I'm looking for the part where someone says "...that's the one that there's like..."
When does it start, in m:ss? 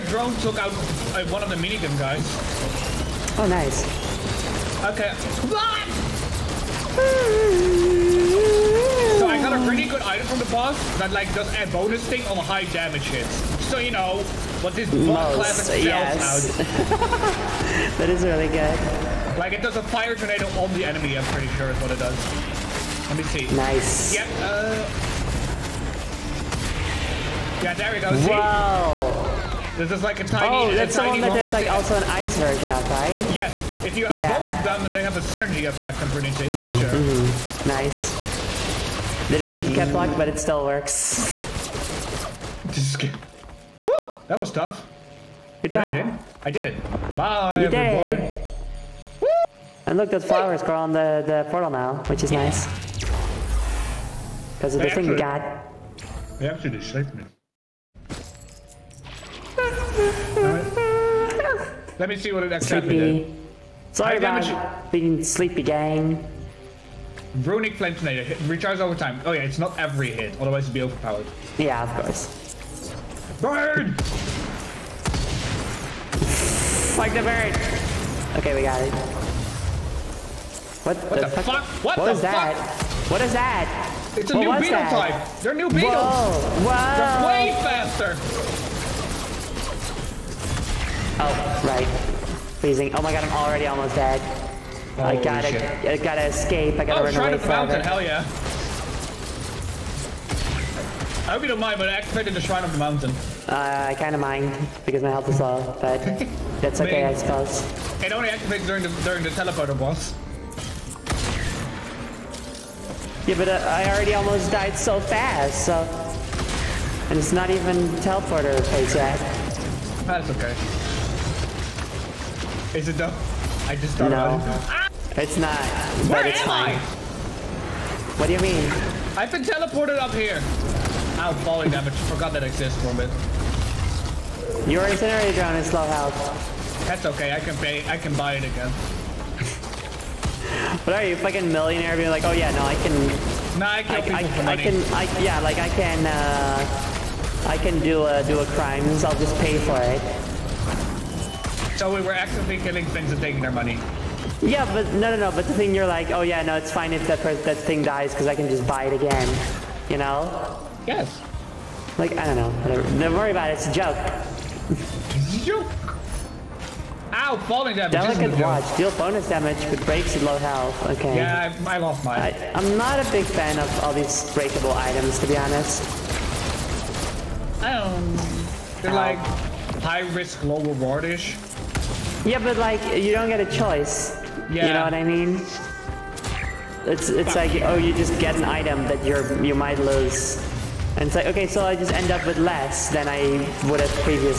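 0:30.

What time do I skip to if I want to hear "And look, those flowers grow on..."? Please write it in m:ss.
0:49.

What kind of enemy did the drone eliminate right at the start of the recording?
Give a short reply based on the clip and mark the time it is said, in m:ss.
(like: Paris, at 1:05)
minigun guys, at 0:01.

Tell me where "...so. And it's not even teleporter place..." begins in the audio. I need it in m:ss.
1:55.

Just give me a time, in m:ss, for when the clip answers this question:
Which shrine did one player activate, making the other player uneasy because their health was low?
1:42.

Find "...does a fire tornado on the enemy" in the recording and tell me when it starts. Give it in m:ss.
0:19.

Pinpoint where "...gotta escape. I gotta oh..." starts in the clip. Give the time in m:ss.
1:35.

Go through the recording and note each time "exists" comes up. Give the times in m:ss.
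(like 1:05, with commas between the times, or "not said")
2:12.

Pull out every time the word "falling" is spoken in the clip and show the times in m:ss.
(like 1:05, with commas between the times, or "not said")
2:11, 2:47.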